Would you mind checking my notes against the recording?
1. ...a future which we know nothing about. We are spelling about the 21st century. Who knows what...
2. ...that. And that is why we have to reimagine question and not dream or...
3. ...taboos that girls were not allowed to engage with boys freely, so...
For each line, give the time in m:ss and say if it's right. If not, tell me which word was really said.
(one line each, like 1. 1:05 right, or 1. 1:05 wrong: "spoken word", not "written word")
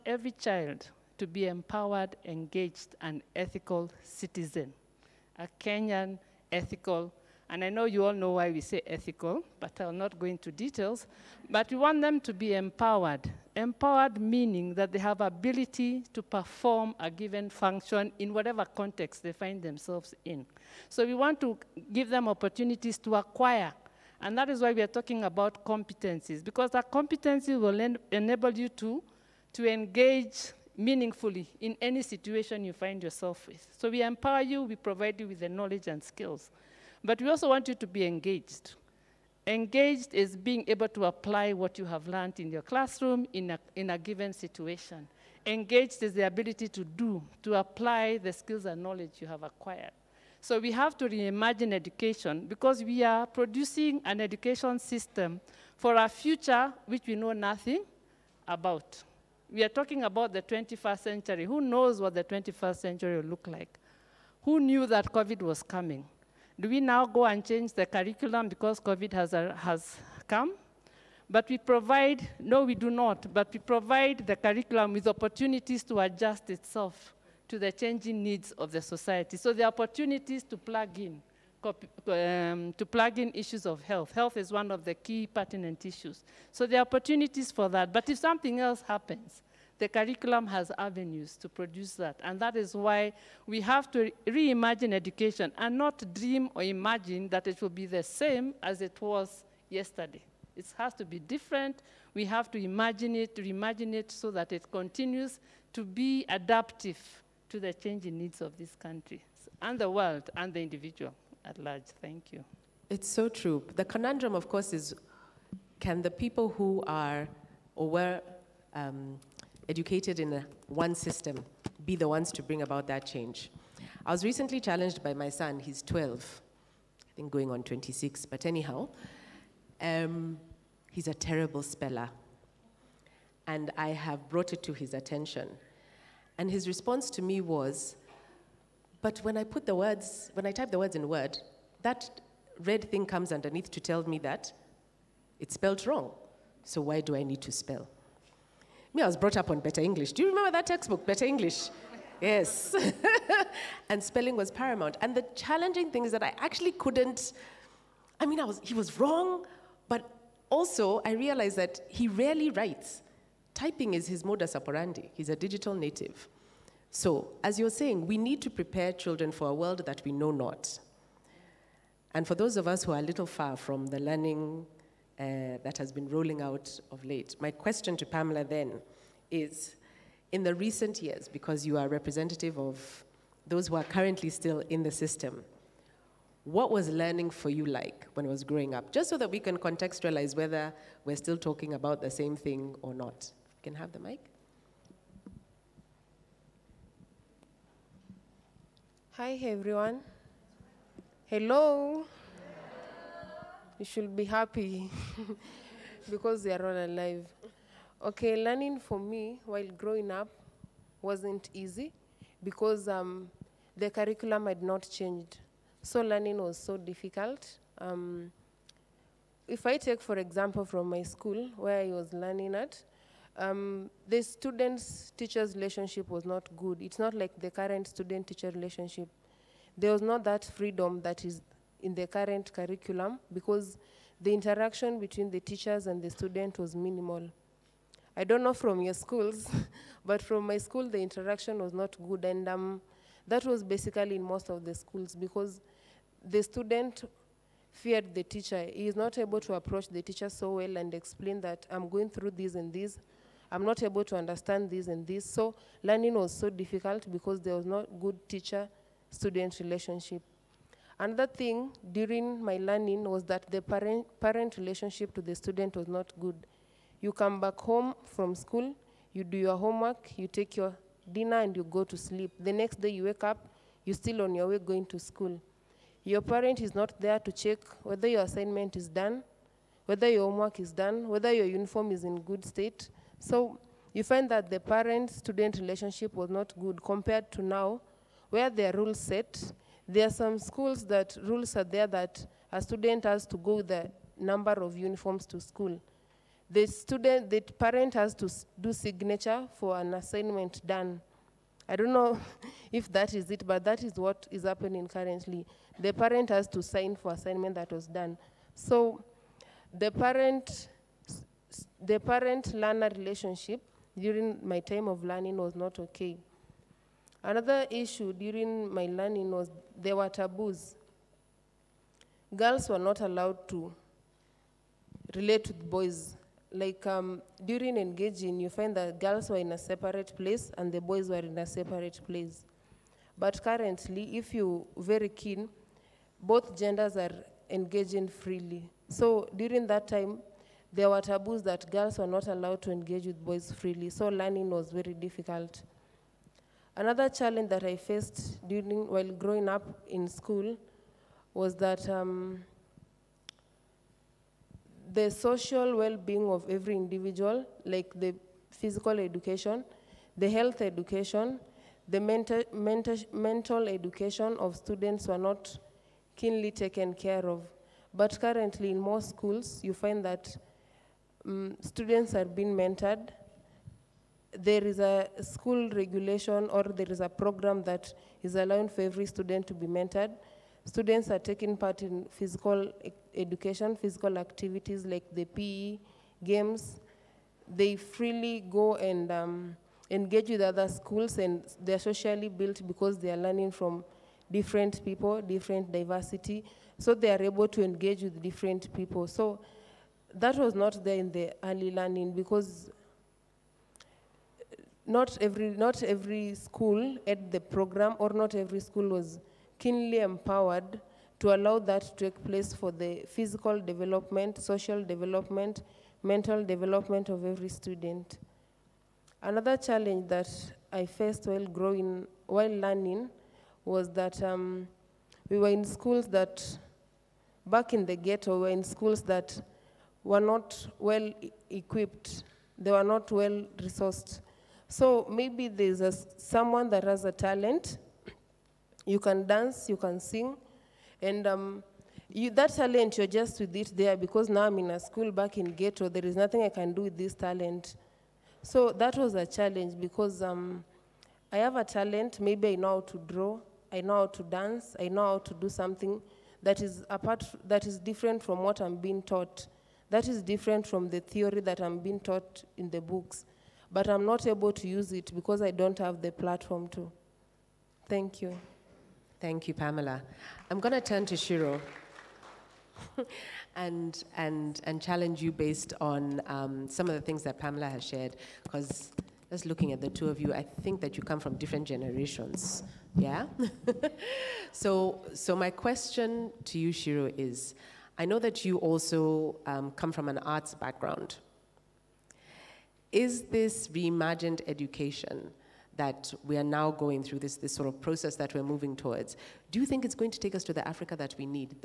1. 0:55 wrong: "talking", not "spelling"
2. 1:31 wrong: "education", not "question"
3. 5:41 right.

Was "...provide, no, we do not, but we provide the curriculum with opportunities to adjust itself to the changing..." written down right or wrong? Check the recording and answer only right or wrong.
right.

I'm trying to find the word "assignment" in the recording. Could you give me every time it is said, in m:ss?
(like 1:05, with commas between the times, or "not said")
4:38, 4:59, 5:07.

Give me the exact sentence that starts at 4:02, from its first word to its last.
And um, that was basically in most of the schools because the student feared the teacher.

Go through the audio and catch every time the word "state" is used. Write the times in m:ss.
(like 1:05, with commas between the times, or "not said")
4:42.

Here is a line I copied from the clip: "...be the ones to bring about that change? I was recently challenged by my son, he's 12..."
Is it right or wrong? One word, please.
right.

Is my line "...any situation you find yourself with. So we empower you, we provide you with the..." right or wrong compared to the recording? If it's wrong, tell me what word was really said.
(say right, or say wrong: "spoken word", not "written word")
right.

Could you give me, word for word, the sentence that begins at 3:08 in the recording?
Just so that we can contextualize whether we're still talking about the same thing or not can have the mic.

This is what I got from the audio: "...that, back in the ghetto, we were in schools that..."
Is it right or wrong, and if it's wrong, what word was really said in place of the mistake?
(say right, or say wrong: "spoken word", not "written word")
right.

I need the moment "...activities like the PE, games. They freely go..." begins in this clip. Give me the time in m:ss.
6:24.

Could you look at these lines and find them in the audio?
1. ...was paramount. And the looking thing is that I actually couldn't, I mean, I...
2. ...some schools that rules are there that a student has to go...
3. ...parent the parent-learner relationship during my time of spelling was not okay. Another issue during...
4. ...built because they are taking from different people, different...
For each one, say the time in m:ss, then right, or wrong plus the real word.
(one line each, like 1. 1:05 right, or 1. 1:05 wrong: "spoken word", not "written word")
1. 2:34 wrong: "challenging", not "looking"
2. 4:50 right
3. 5:09 wrong: "learning", not "spelling"
4. 6:32 wrong: "learning", not "taking".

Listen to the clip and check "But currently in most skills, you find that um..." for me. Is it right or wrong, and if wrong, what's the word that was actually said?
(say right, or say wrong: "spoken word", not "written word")
wrong: "schools", not "skills".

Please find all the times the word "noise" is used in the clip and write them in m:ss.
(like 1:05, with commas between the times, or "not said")
not said.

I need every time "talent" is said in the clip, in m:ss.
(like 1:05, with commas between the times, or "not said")
7:17, 7:22, 7:27, 7:31.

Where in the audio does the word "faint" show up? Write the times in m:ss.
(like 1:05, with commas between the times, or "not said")
not said.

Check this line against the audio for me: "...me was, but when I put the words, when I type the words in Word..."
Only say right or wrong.
right.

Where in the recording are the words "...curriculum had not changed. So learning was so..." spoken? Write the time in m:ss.
3:33.